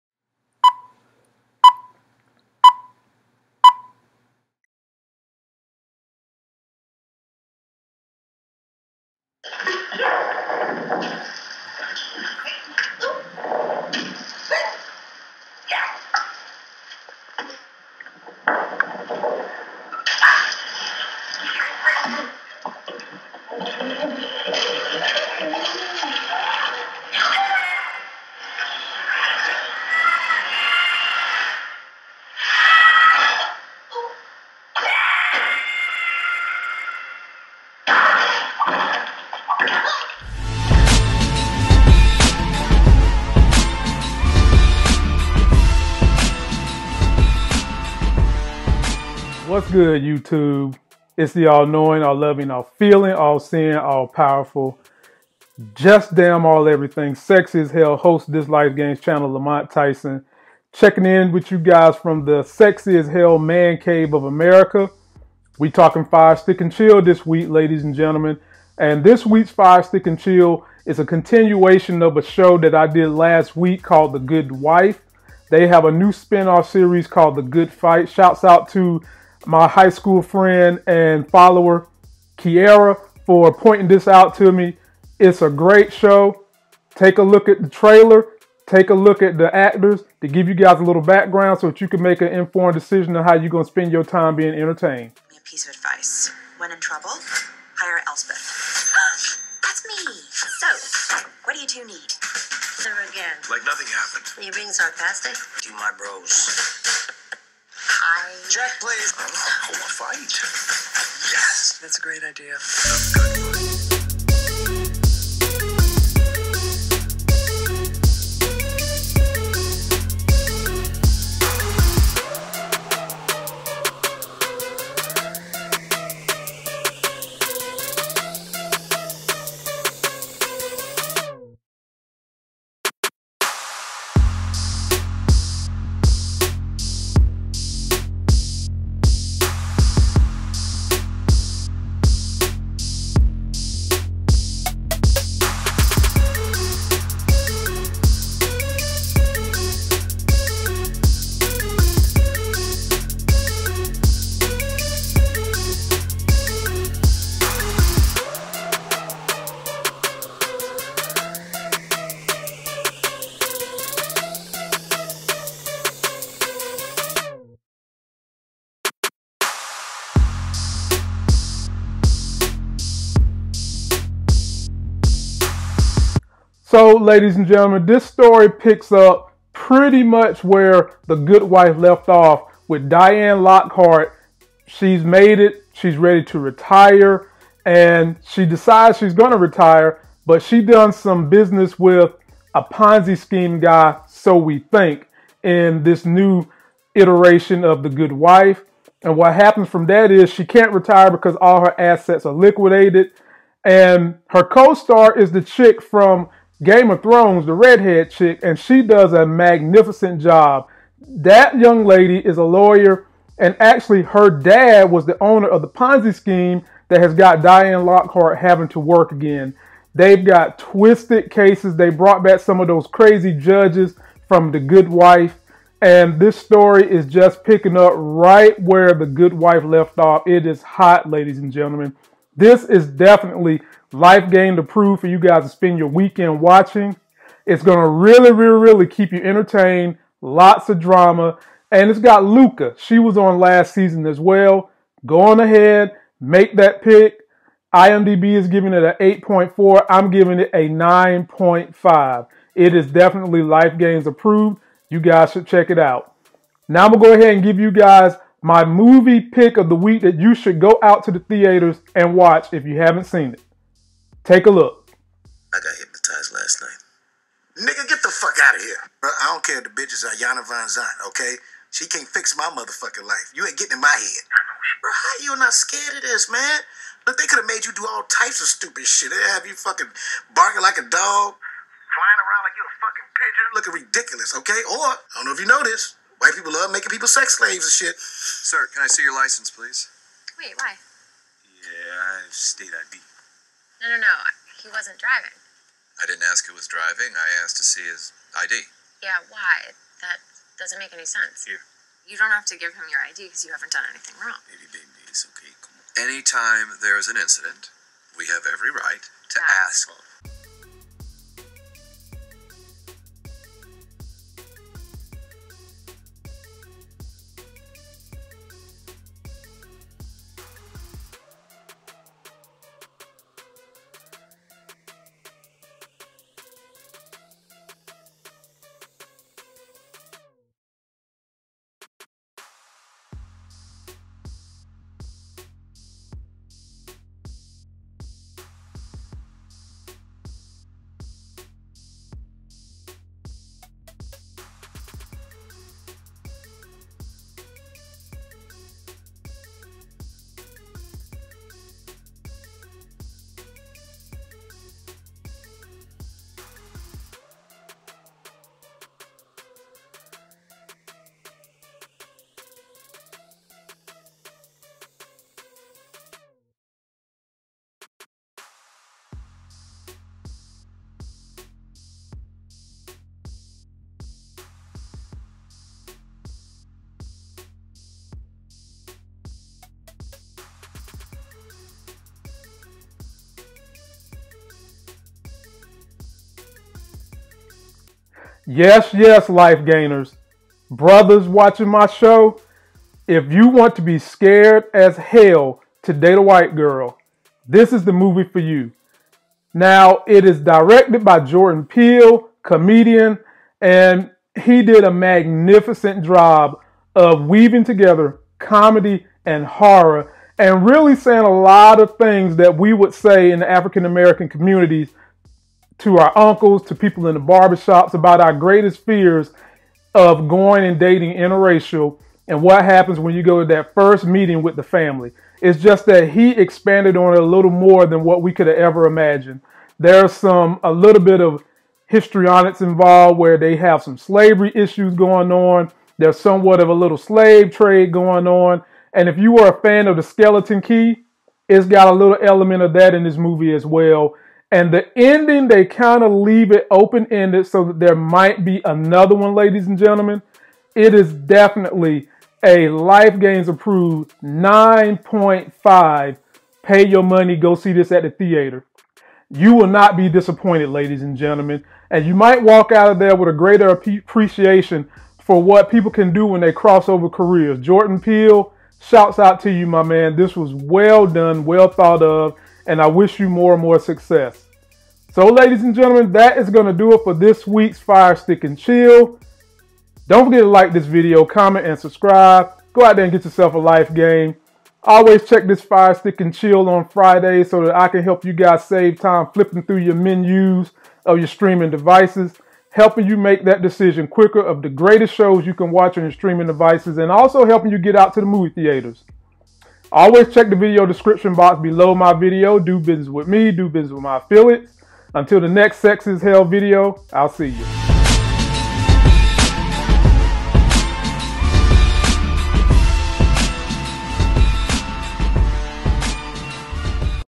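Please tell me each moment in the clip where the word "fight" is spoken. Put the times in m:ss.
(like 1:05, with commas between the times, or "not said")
1:17, 1:49.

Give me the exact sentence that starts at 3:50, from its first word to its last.
It is hot, ladies and gentlemen.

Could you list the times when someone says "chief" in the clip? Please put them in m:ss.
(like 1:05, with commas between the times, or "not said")
not said.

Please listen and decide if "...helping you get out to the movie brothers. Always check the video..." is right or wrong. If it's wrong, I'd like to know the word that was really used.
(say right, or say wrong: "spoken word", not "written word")
wrong: "theaters", not "brothers".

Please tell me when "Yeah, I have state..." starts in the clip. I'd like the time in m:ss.
4:51.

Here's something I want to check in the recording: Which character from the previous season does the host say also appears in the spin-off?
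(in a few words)
Lucca.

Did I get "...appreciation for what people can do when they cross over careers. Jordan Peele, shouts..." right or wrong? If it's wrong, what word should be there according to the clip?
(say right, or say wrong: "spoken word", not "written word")
right.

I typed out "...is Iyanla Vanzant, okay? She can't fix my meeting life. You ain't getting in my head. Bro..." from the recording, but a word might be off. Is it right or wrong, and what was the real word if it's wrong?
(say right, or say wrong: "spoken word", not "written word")
wrong: "motherfucking", not "meeting".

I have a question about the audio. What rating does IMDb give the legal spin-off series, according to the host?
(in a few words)
8.4.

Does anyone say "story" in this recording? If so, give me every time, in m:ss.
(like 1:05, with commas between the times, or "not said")
2:58, 3:46.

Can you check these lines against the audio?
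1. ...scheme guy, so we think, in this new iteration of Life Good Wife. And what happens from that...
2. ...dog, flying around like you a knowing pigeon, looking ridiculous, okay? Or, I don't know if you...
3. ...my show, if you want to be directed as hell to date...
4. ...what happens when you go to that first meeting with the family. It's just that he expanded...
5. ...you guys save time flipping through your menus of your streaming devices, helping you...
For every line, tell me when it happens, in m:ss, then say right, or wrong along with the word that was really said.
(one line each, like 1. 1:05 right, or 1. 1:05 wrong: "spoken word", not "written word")
1. 3:13 wrong: "The", not "Life"
2. 4:40 wrong: "fucking", not "knowing"
3. 6:31 wrong: "scared", not "directed"
4. 7:02 right
5. 8:08 right.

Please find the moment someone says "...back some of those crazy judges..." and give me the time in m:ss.
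3:42.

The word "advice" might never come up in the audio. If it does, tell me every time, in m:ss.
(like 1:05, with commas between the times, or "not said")
1:35.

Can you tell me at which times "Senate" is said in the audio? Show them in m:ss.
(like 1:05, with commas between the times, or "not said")
not said.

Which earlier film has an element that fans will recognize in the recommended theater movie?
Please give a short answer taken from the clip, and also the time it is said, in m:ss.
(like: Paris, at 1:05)
The Skeleton Key, at 7:20.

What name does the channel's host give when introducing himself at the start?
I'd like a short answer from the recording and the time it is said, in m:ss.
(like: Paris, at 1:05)
Lamont Tyson, at 0:59.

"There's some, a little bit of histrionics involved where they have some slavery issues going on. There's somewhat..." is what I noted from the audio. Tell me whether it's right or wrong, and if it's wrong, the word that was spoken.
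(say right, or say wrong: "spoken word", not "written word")
right.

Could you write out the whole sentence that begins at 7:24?
And the ending, they kind of leave it open ended so that there might be another one, ladies and gentlemen.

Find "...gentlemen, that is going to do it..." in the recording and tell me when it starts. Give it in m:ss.
7:55.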